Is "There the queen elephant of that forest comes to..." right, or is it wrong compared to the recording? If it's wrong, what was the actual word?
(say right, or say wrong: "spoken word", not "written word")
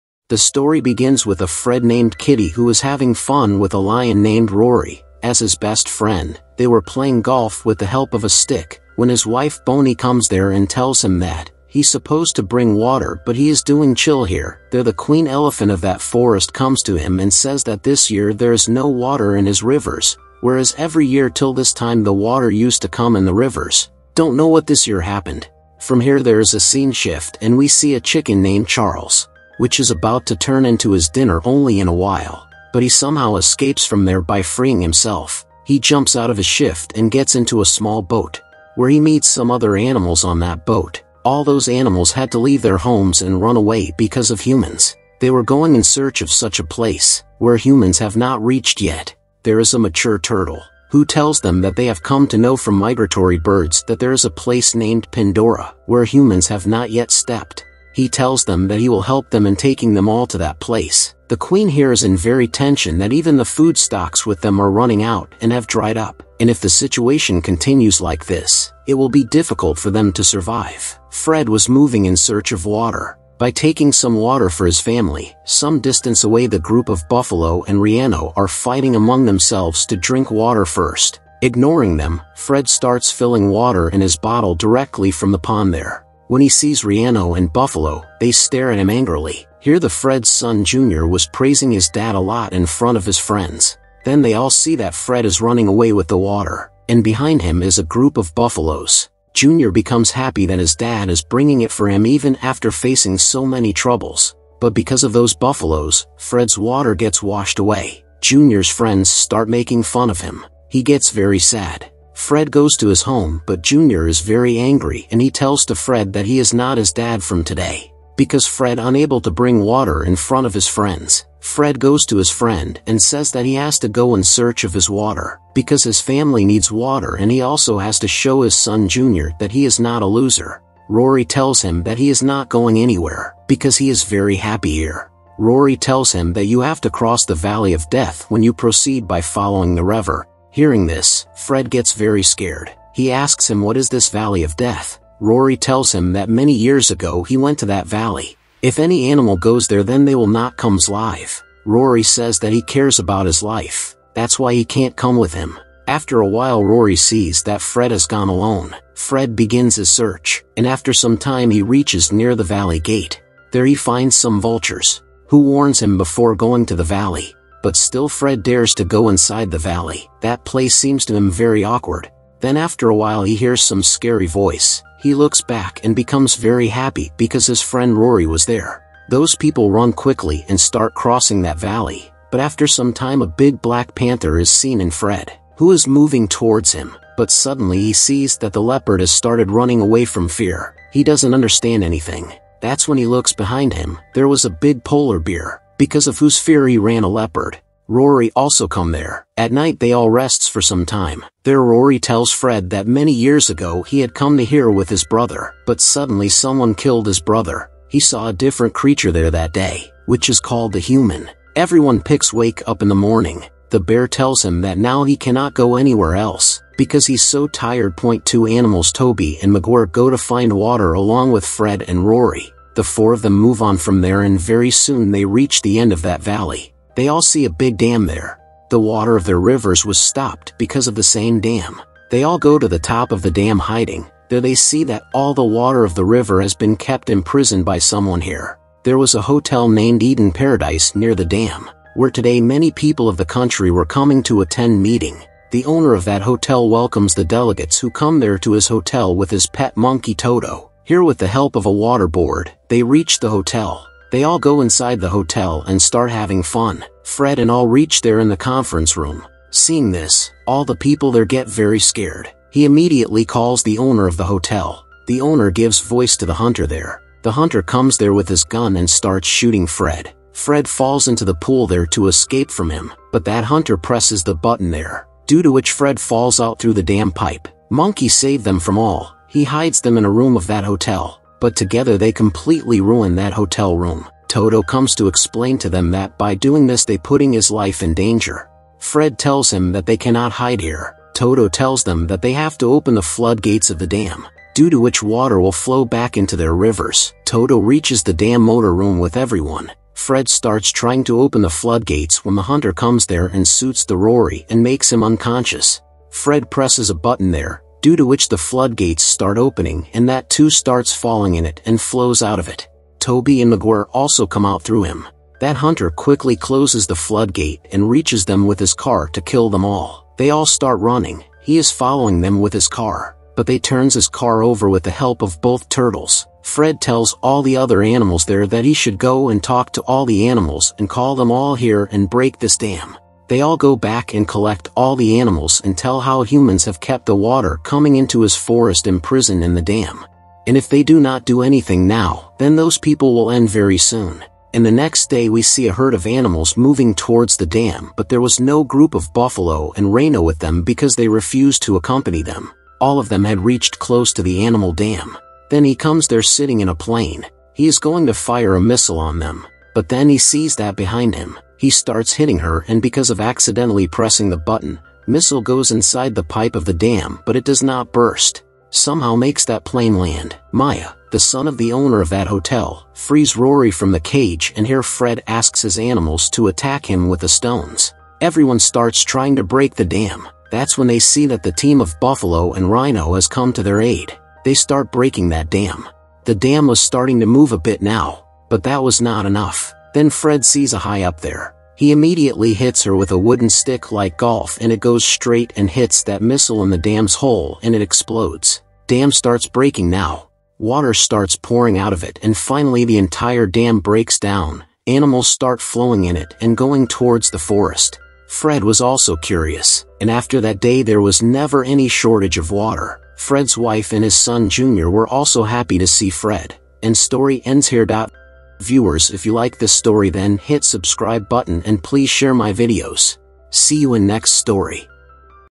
right.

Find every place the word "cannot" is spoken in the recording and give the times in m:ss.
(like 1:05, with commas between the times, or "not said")
3:35, 4:49.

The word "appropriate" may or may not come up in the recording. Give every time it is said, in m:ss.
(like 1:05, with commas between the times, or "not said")
not said.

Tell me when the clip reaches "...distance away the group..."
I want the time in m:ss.
1:15.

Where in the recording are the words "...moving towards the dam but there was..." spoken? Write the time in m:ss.
5:46.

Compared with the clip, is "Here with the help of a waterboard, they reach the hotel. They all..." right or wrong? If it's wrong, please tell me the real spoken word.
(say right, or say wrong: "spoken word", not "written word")
right.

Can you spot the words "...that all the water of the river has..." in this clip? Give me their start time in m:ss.
3:54.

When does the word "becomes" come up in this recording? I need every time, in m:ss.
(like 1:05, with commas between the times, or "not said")
1:39, 2:55.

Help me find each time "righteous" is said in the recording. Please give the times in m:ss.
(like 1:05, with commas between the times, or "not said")
not said.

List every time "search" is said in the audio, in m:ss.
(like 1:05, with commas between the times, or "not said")
0:45, 1:12, 2:04, 2:39.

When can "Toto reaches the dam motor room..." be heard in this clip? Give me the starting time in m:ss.
4:57.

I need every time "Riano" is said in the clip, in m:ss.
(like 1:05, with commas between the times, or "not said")
1:17, 1:26.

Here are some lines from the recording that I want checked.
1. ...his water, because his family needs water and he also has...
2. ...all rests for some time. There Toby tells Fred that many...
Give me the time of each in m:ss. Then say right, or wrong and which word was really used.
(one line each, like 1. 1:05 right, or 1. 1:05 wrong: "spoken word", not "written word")
1. 2:04 right
2. 3:19 wrong: "Rory", not "Toby".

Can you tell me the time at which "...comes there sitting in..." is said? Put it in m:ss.
5:55.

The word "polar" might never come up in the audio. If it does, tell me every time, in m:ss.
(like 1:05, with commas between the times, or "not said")
3:14.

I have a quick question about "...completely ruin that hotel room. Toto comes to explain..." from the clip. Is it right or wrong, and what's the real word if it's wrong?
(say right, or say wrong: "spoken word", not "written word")
right.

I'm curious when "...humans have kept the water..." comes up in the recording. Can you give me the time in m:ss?
5:36.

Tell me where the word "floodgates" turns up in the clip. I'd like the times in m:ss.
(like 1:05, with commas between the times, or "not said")
4:53, 5:01, 5:08, 5:16.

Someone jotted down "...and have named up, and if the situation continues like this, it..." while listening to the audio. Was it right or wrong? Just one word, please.
wrong.